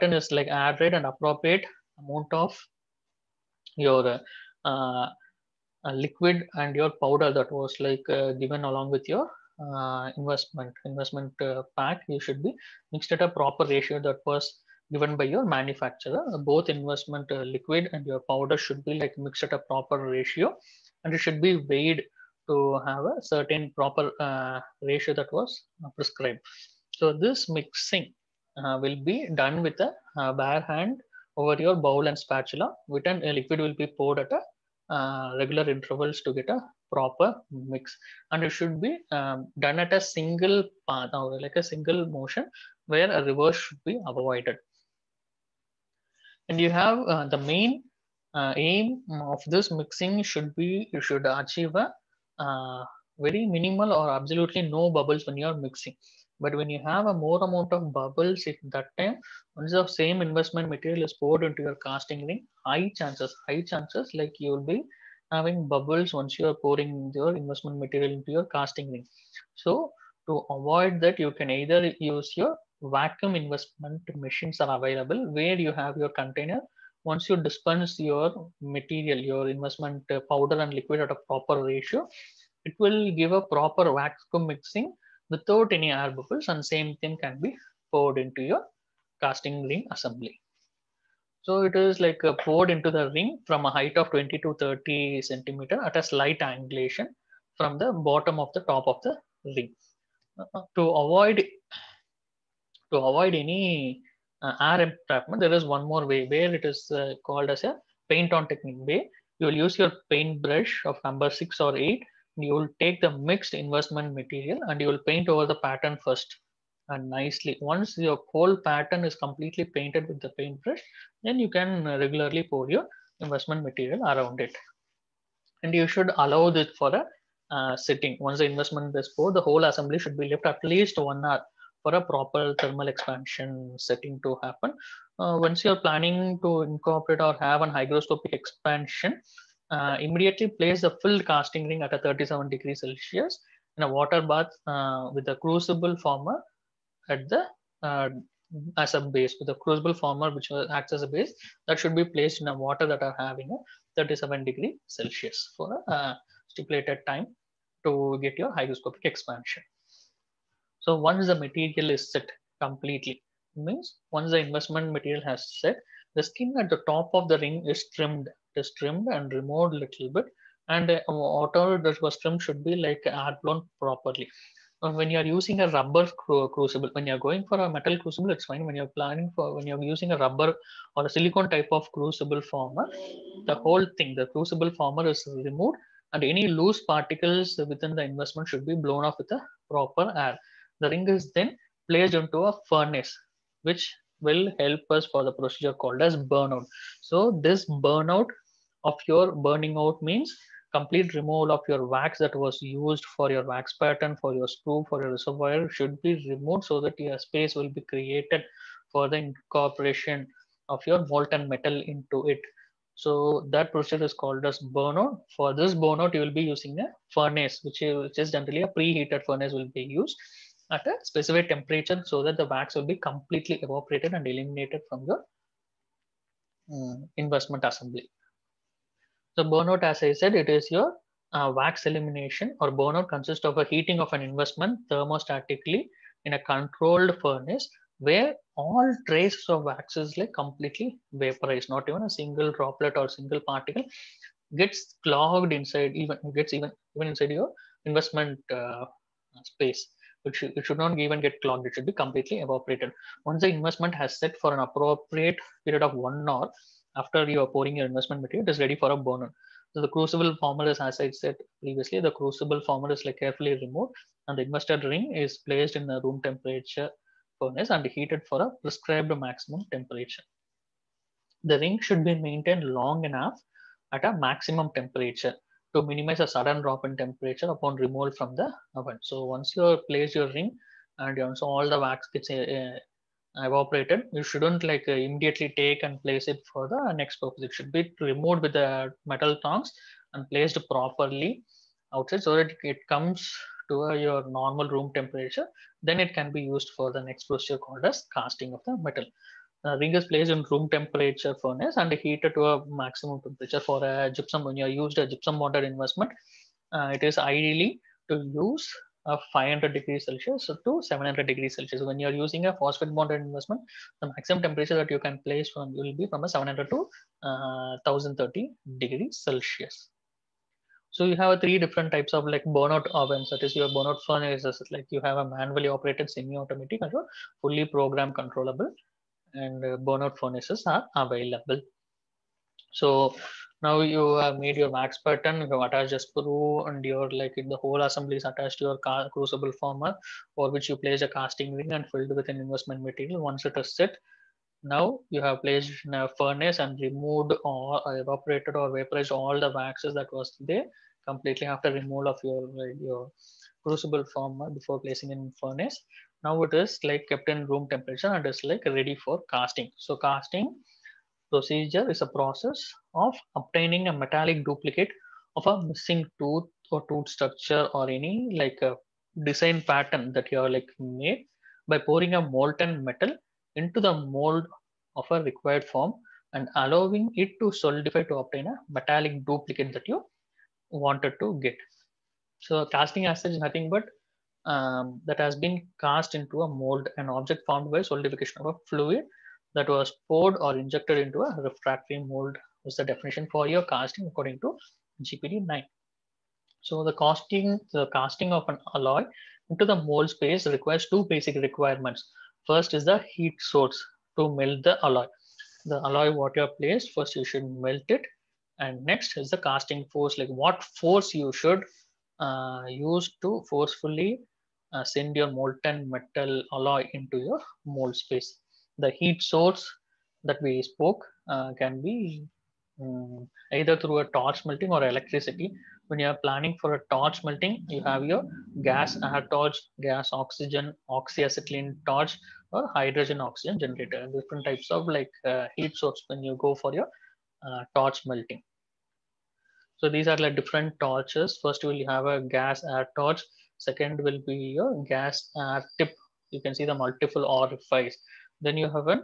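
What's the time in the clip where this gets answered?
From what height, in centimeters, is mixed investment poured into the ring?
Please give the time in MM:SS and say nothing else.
01:34.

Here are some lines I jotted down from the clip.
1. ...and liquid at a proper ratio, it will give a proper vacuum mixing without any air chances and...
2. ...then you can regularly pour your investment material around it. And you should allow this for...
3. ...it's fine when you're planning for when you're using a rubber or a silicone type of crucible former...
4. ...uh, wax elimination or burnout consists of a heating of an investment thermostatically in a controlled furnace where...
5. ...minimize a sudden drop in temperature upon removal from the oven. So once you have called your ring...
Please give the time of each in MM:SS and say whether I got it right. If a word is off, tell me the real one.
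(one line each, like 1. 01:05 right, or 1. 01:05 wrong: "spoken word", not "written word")
1. 01:20 wrong: "bubbles", not "chances"
2. 02:01 right
3. 02:58 right
4. 03:51 right
5. 04:35 wrong: "placed", not "called".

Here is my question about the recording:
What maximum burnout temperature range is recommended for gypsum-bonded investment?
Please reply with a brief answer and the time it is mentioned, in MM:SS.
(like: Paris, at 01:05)
500 to 700 degrees Celsius, at 05:09.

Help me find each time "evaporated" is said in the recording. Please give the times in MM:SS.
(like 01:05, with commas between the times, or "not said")
03:43, 04:12, 05:48.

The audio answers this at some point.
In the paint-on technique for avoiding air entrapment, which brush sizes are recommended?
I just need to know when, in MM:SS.
01:51.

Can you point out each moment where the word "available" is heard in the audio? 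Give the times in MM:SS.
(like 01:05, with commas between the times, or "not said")
01:14, 05:30.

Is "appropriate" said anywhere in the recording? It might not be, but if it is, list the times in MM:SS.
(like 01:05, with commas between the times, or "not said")
00:01, 04:14.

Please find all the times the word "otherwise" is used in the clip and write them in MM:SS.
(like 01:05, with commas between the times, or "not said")
not said.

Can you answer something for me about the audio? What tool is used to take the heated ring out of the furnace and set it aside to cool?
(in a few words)
metal tongs.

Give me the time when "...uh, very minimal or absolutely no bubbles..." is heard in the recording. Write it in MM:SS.
00:52.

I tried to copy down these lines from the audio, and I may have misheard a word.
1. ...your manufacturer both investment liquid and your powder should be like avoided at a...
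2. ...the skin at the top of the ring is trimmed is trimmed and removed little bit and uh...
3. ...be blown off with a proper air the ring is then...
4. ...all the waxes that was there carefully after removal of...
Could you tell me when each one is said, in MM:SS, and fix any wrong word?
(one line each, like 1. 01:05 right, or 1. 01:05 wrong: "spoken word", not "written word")
1. 00:15 wrong: "mixed", not "avoided"
2. 02:46 right
3. 03:08 right
4. 05:49 wrong: "completely", not "carefully".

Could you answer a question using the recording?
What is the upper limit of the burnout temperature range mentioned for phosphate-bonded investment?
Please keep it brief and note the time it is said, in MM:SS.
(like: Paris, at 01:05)
1030 degrees Celsius, at 05:17.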